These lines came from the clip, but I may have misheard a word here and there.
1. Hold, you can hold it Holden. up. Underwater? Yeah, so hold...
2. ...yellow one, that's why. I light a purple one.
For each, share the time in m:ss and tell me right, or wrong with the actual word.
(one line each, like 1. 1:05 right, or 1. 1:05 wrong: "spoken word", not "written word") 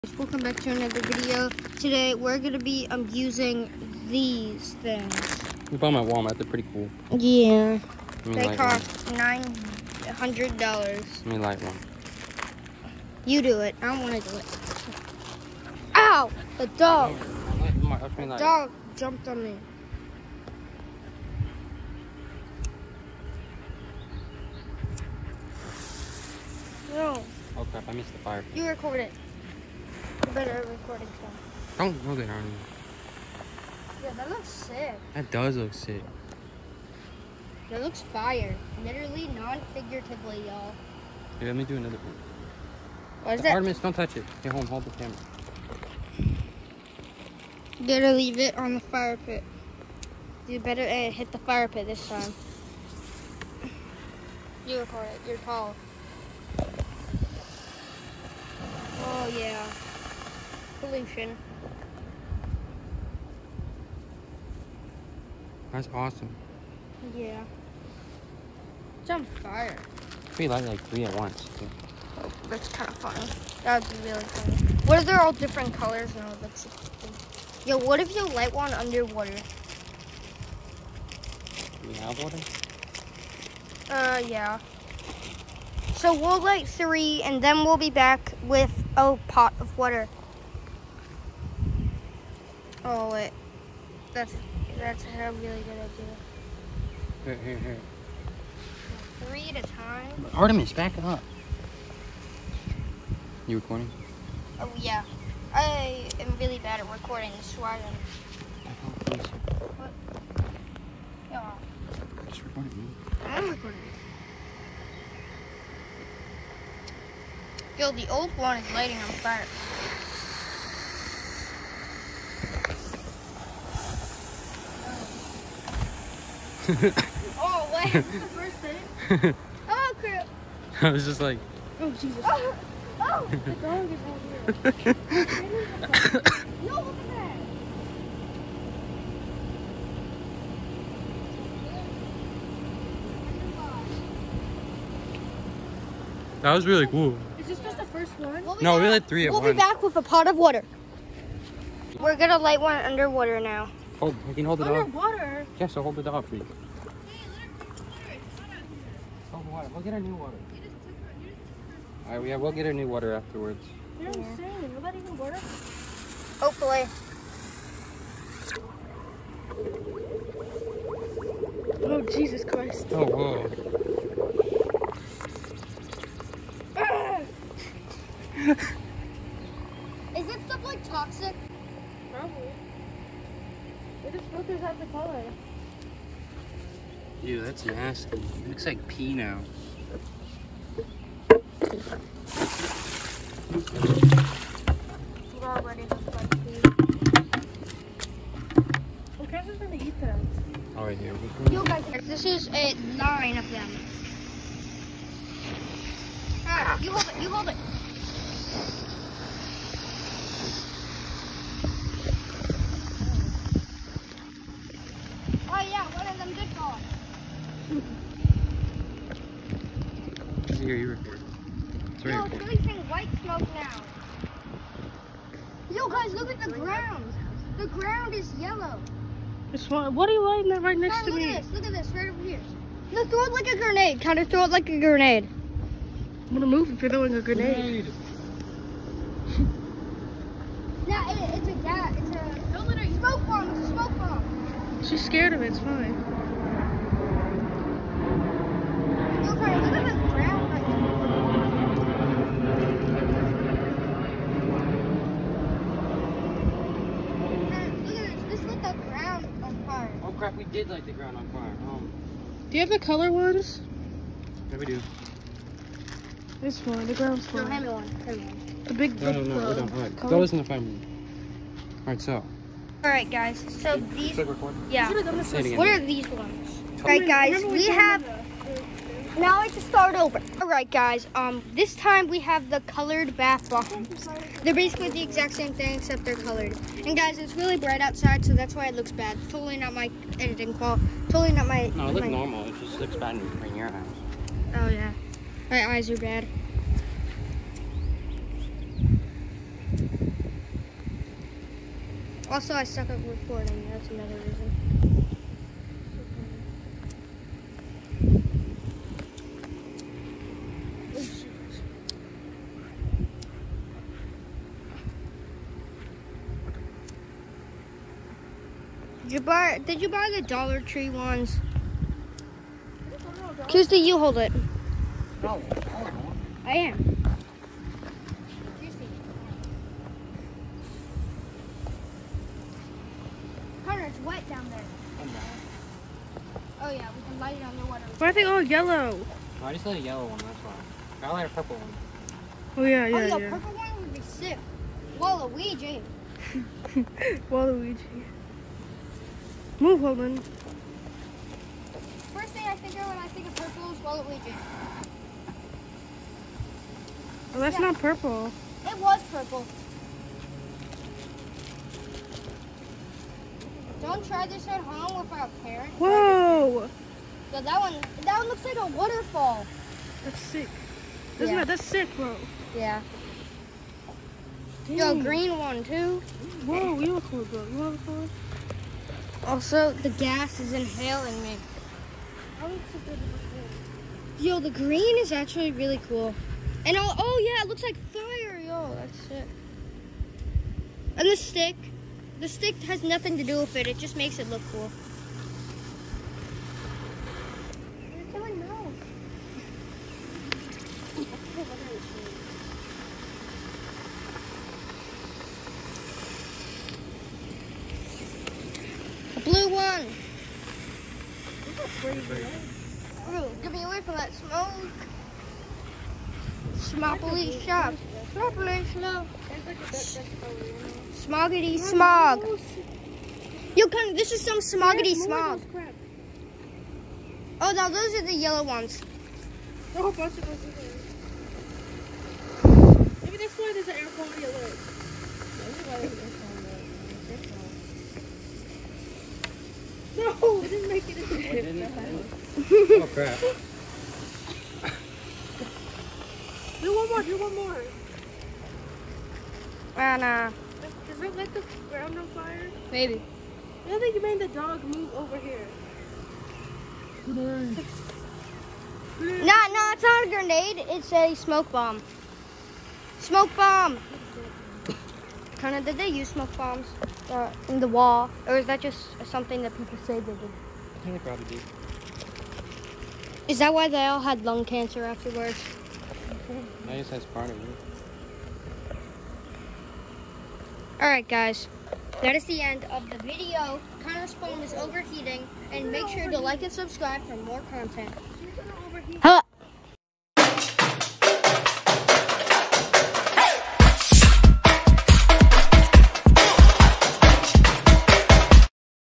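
1. 2:34 wrong: "Underwater", not "Holden"
2. 5:39 right.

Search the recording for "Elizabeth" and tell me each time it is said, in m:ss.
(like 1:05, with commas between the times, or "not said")
not said.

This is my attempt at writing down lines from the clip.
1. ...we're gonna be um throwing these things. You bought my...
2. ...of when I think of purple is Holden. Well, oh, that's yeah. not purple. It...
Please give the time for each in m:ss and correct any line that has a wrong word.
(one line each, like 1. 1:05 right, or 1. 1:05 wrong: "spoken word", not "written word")
1. 0:02 wrong: "using", not "throwing"
2. 5:52 wrong: "Waluigi", not "Holden".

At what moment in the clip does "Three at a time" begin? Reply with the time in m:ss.
1:39.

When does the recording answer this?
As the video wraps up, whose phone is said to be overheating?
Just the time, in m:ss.
8:03.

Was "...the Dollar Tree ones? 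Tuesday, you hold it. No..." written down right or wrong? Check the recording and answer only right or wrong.
right.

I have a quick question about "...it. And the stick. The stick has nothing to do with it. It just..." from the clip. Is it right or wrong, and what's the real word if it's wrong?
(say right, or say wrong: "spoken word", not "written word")
right.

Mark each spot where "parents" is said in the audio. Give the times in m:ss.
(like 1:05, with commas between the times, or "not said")
6:05.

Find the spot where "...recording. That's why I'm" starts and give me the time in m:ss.
1:46.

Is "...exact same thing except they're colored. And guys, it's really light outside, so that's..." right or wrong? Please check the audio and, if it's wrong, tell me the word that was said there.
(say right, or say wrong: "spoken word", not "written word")
wrong: "bright", not "light".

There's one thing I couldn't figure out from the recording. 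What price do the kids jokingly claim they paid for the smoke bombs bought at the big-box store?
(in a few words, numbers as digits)
$900.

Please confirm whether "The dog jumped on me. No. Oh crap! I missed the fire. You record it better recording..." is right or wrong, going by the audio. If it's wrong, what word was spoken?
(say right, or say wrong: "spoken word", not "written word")
right.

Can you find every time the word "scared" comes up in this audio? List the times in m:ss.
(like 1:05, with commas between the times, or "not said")
4:05.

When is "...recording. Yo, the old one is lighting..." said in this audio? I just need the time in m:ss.
1:53.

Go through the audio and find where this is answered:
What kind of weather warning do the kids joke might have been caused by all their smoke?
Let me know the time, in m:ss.
7:13.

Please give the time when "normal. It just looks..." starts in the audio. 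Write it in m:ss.
4:52.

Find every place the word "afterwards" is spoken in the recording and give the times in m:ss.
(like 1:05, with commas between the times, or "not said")
2:43, 7:54.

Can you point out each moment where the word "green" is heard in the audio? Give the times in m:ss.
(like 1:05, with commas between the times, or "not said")
6:15, 6:24.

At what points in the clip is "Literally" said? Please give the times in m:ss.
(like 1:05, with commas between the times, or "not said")
0:38.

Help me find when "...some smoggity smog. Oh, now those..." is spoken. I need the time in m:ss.
7:04.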